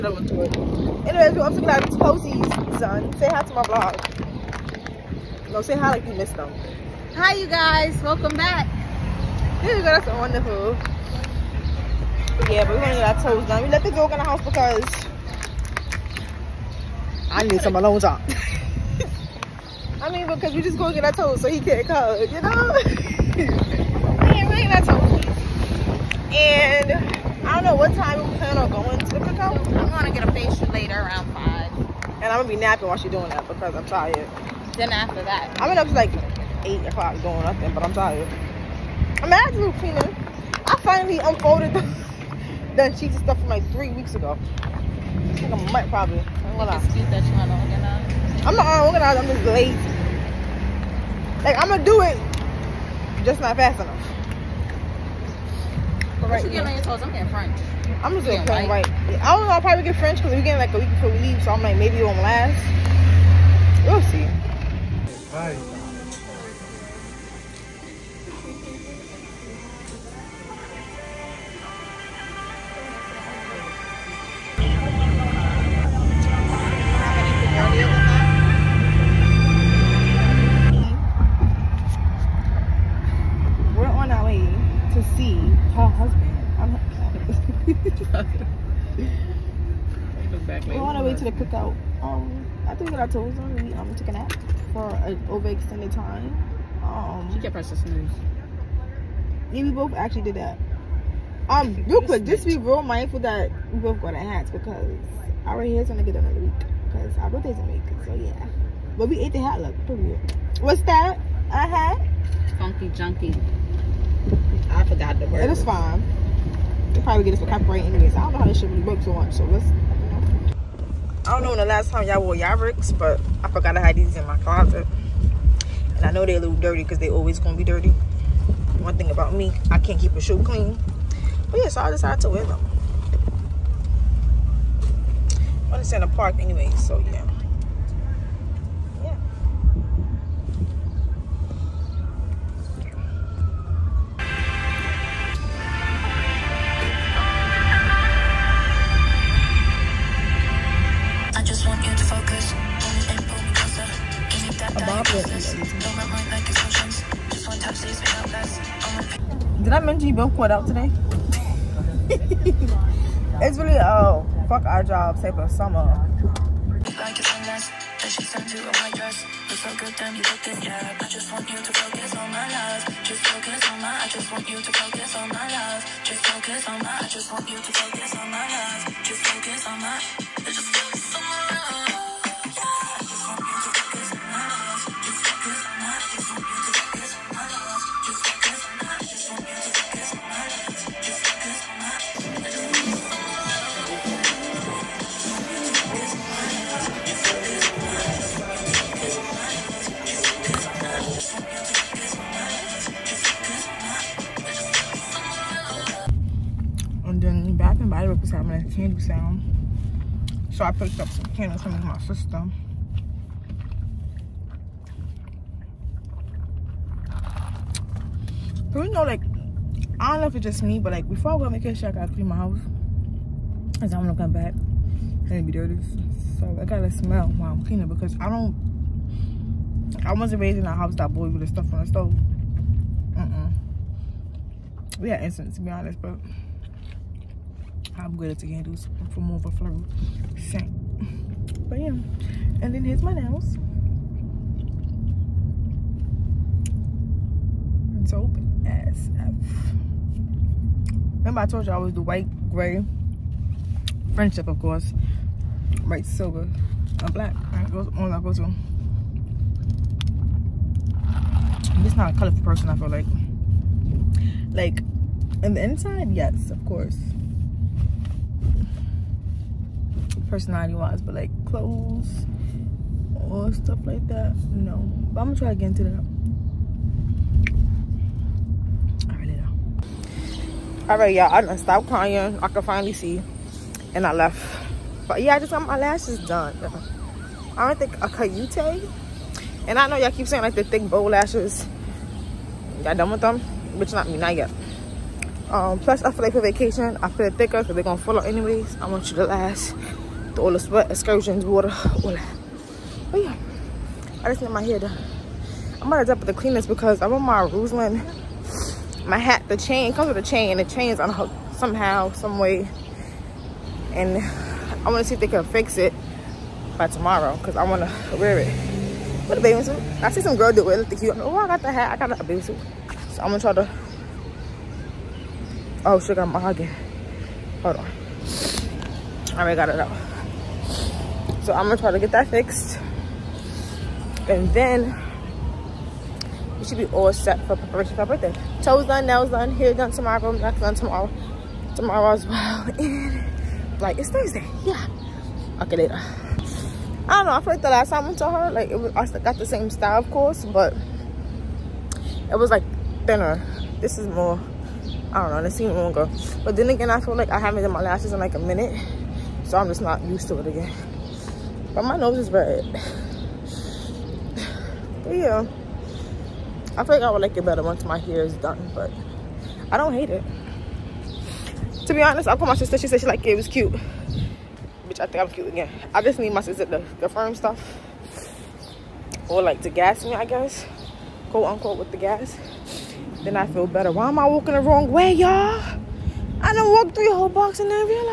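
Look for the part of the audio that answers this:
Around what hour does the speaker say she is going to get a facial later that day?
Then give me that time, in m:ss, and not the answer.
0:30.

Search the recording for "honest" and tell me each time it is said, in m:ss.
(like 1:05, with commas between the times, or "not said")
3:55, 6:12.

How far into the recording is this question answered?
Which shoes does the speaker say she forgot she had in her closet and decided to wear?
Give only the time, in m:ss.
2:02.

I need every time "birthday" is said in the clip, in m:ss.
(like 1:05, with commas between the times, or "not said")
1:47, 5:38.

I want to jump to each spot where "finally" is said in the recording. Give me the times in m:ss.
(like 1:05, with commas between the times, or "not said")
0:40, 4:42.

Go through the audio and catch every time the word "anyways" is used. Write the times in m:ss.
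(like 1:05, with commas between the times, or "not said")
0:01, 1:57, 2:16, 4:58.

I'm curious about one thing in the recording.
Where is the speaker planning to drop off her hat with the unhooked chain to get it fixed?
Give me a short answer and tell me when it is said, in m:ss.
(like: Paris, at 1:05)
the cleaners, at 5:06.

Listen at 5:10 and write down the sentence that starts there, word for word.
The chain's unhooked somehow, some way.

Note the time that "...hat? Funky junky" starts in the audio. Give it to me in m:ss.
1:51.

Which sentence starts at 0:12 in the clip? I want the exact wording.
yeah, but we're gonna get our toes done.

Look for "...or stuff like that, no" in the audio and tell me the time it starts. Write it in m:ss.
4:33.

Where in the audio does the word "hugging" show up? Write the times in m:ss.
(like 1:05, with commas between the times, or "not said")
5:26.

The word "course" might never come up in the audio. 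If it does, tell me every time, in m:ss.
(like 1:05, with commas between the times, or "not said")
4:14, 4:26, 5:50.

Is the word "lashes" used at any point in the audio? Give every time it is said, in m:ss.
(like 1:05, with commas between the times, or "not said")
4:45, 4:51, 5:57.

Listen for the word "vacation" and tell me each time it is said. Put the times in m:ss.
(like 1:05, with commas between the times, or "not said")
3:41, 4:56.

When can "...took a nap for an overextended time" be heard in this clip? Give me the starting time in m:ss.
1:33.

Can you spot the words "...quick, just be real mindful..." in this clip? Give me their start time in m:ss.
1:42.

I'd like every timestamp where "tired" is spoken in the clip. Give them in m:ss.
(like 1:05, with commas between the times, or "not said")
0:33, 0:37.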